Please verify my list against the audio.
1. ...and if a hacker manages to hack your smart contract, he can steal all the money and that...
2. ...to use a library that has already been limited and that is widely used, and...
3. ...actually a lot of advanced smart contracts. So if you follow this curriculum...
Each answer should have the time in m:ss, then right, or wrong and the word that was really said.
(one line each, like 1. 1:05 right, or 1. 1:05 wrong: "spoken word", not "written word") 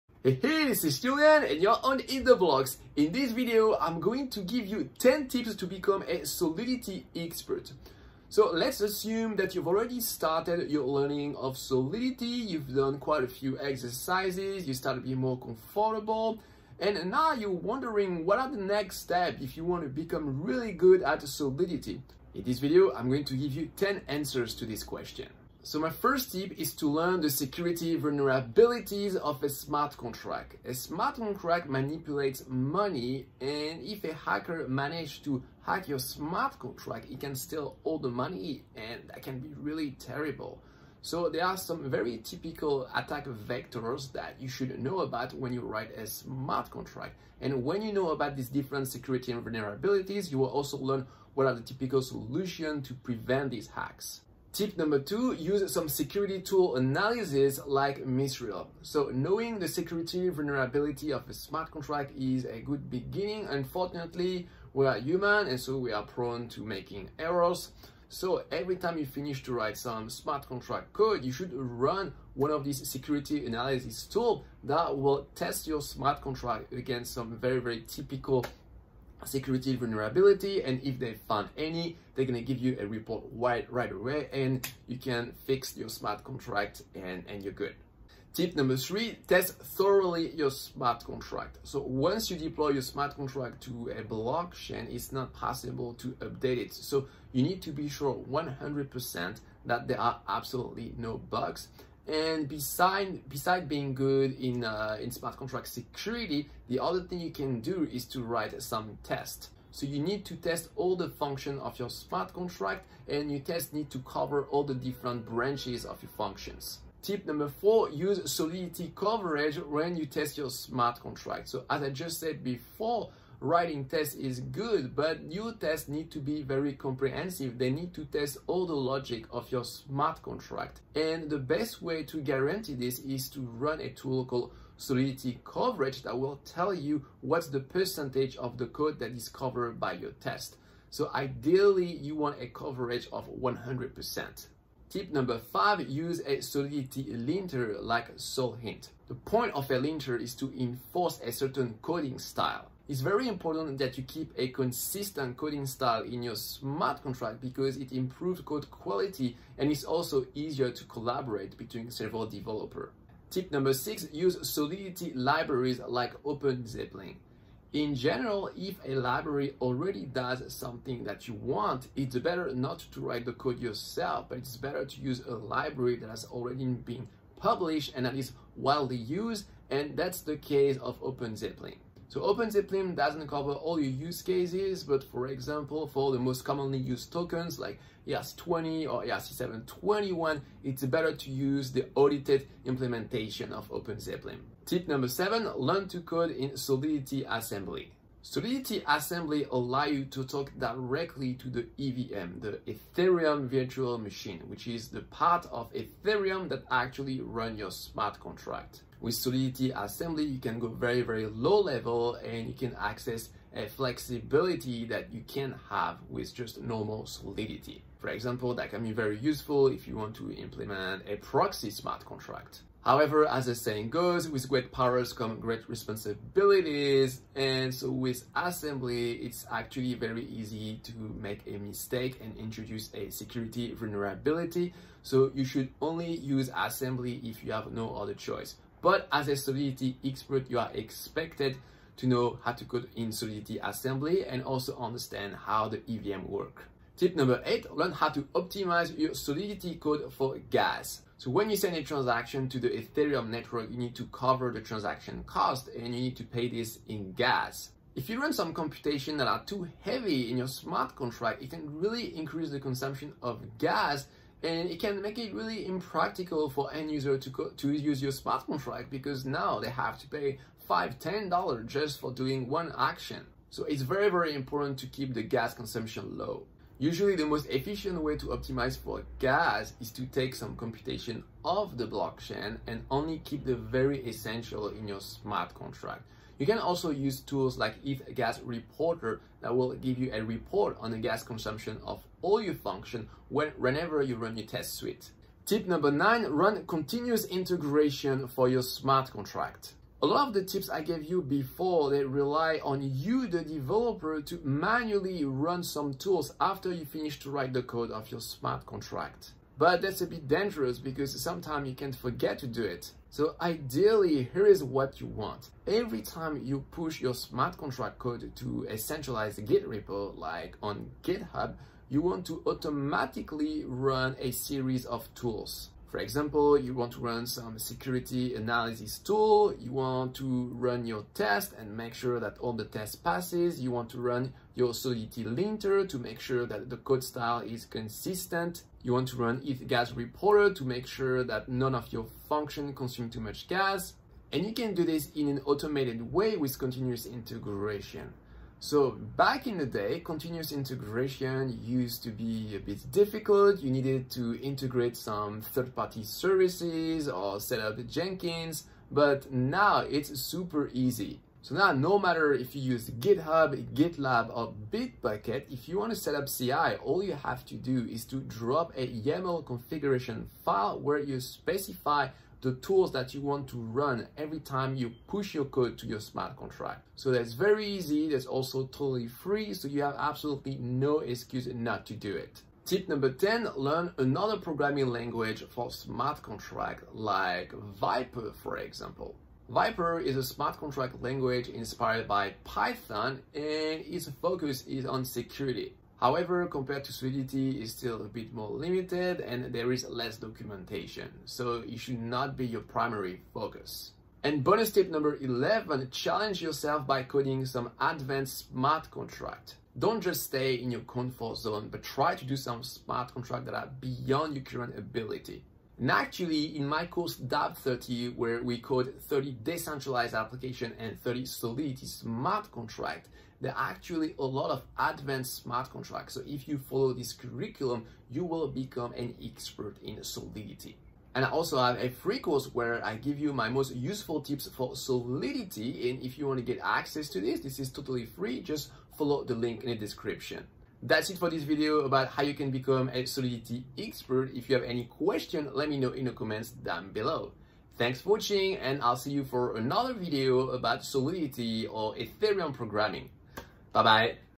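1. 0:33 right
2. 2:54 wrong: "published", not "limited"
3. 7:03 right.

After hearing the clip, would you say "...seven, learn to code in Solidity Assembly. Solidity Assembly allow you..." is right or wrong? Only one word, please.
right.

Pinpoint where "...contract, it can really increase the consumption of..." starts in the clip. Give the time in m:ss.
4:20.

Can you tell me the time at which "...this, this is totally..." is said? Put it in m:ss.
7:17.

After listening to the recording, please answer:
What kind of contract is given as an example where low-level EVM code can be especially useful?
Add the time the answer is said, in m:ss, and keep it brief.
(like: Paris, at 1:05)
proxy smart contract, at 3:41.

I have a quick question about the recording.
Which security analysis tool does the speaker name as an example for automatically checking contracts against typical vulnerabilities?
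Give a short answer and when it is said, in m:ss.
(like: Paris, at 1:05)
Mythril, at 0:58.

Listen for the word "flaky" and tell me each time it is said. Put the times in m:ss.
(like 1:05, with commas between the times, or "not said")
not said.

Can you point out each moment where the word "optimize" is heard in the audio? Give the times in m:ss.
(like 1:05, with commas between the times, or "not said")
4:08, 4:38.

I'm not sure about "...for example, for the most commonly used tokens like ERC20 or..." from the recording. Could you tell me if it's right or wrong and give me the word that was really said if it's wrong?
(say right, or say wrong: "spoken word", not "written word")
right.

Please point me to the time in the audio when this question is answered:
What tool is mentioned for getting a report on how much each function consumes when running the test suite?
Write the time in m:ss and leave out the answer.
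4:47.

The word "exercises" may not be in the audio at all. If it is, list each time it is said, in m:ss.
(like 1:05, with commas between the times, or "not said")
0:13.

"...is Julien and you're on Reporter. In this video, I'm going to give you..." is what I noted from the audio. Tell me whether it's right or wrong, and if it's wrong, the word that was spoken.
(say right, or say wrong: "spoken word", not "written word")
wrong: "EatTheBlocks", not "Reporter".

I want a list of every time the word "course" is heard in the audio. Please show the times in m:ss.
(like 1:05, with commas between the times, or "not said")
6:56, 7:12.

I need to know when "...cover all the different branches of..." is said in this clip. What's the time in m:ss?
1:53.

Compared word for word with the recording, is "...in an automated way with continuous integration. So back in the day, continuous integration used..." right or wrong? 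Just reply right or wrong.
right.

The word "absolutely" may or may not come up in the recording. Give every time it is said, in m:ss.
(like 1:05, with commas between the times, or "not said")
1:40, 6:19.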